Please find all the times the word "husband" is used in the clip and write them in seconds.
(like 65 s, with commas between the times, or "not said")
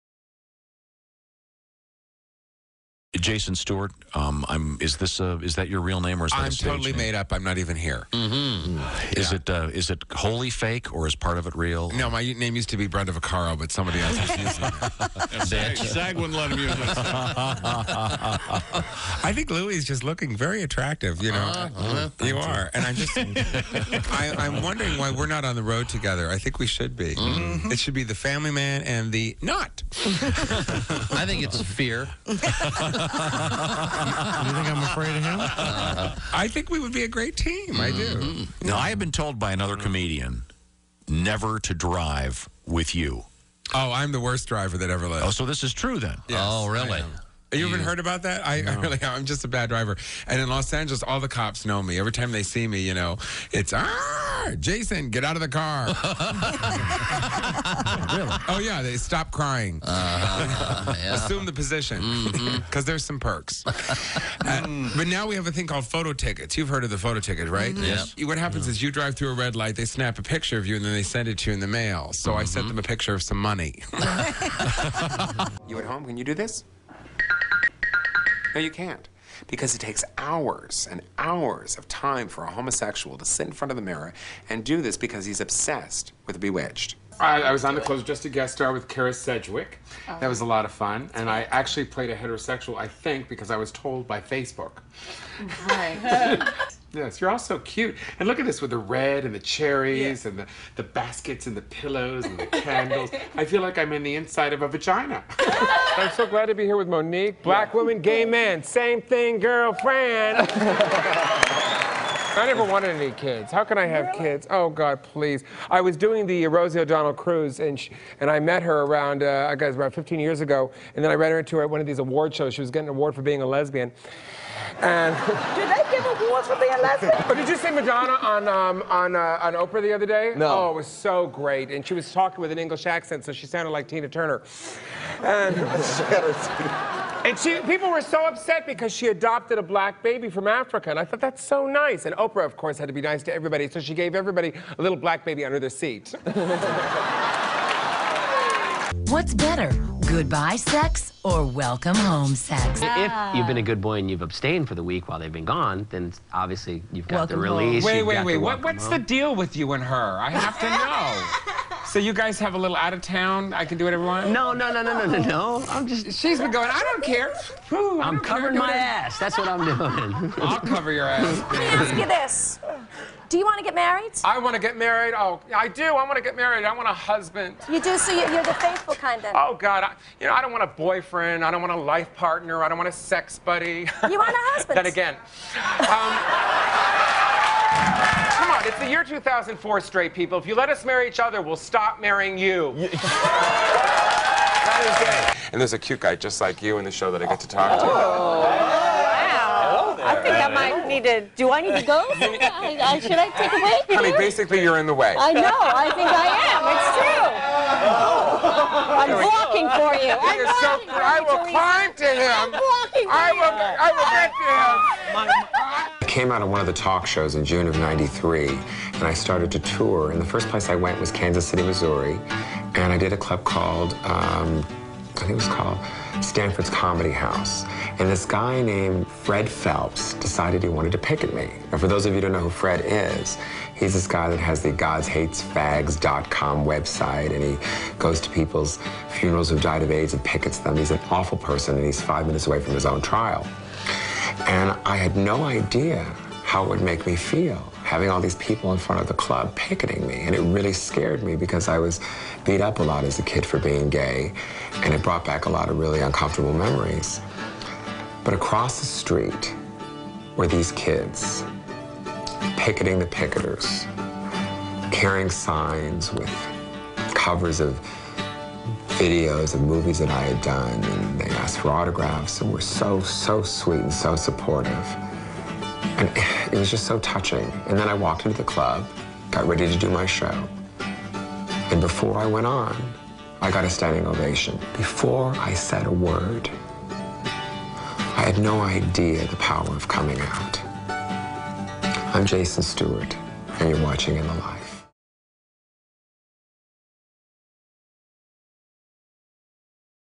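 176 s, 184 s.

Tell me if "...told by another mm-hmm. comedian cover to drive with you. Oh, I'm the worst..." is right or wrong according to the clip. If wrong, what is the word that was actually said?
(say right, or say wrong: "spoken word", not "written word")
wrong: "never", not "cover".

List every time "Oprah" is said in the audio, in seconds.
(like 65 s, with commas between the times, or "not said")
129 s, 142 s.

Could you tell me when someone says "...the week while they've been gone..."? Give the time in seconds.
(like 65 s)
154 s.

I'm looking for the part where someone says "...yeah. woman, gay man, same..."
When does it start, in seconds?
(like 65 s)
107 s.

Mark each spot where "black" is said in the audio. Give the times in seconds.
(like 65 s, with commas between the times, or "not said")
107 s, 139 s, 144 s.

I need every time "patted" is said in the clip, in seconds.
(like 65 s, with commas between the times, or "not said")
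not said.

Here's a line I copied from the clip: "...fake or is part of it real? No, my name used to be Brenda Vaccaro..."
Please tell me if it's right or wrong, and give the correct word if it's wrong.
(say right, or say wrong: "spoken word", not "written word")
right.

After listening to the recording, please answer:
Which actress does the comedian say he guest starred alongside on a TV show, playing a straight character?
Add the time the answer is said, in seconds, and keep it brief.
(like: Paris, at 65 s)
Kyra Sedgwick, at 88 s.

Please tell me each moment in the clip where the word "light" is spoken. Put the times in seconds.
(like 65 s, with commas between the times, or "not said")
69 s, 294 s.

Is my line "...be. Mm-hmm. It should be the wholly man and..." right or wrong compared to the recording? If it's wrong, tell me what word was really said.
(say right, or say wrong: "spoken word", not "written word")
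wrong: "family", not "wholly".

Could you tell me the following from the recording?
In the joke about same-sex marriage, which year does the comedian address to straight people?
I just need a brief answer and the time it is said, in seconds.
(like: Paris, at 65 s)
2004, at 189 s.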